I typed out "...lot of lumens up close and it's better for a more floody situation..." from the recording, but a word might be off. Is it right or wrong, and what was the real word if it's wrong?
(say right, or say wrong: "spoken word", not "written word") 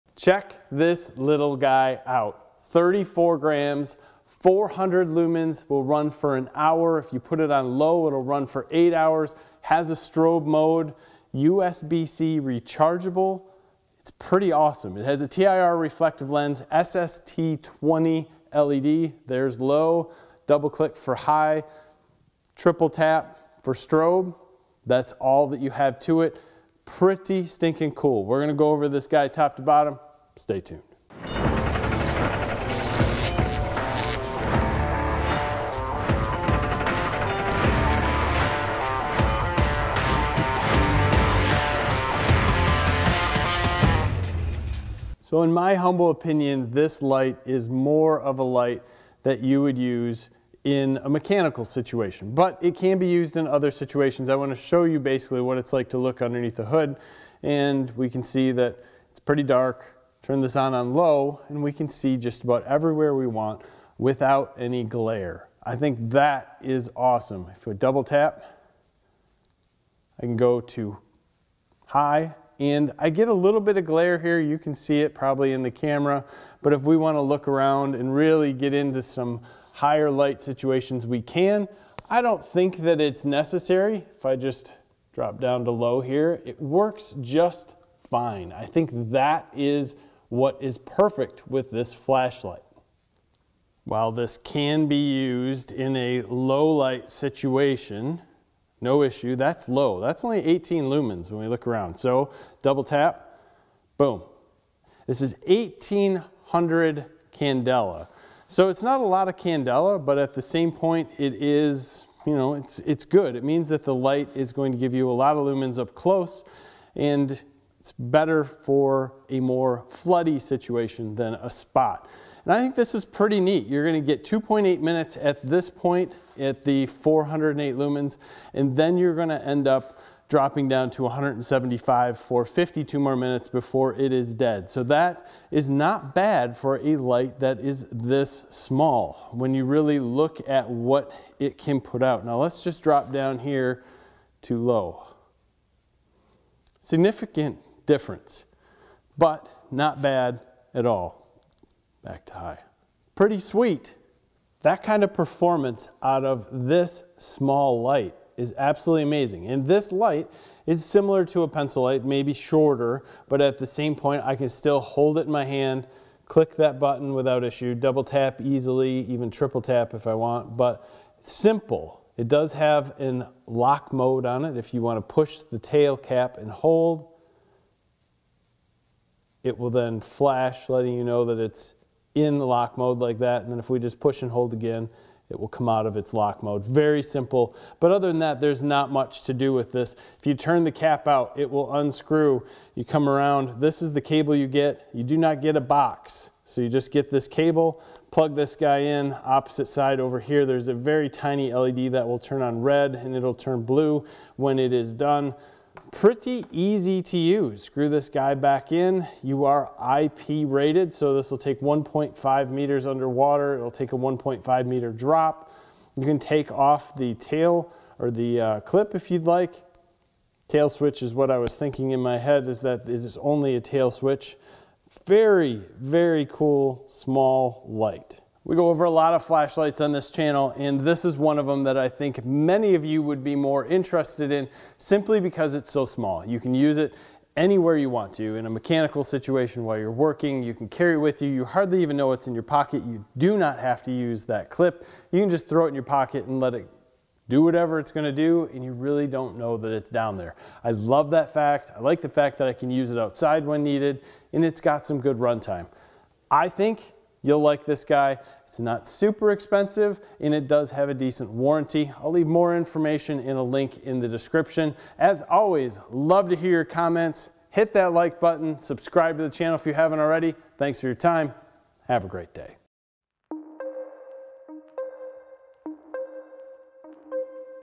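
right.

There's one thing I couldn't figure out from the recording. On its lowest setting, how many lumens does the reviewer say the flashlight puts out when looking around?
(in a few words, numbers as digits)
18 lumens.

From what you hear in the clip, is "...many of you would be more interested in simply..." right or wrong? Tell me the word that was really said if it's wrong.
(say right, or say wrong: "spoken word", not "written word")
right.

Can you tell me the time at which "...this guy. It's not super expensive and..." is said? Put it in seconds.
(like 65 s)
257 s.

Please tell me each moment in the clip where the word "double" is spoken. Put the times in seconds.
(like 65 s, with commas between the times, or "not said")
20 s, 67 s, 102 s, 167 s.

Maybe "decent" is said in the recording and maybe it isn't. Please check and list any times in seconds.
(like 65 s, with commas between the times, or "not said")
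260 s.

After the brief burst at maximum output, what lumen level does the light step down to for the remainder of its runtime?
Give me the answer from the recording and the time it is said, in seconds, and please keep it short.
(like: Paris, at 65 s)
175, at 131 s.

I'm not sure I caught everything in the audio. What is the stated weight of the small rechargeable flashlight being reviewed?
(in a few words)
34 grams.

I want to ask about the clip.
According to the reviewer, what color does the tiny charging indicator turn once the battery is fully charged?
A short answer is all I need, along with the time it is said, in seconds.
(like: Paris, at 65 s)
blue, at 203 s.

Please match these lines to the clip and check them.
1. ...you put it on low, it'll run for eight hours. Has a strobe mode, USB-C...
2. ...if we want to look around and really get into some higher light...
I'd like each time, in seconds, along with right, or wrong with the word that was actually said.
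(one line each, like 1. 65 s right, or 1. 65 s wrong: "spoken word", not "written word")
1. 7 s right
2. 76 s right.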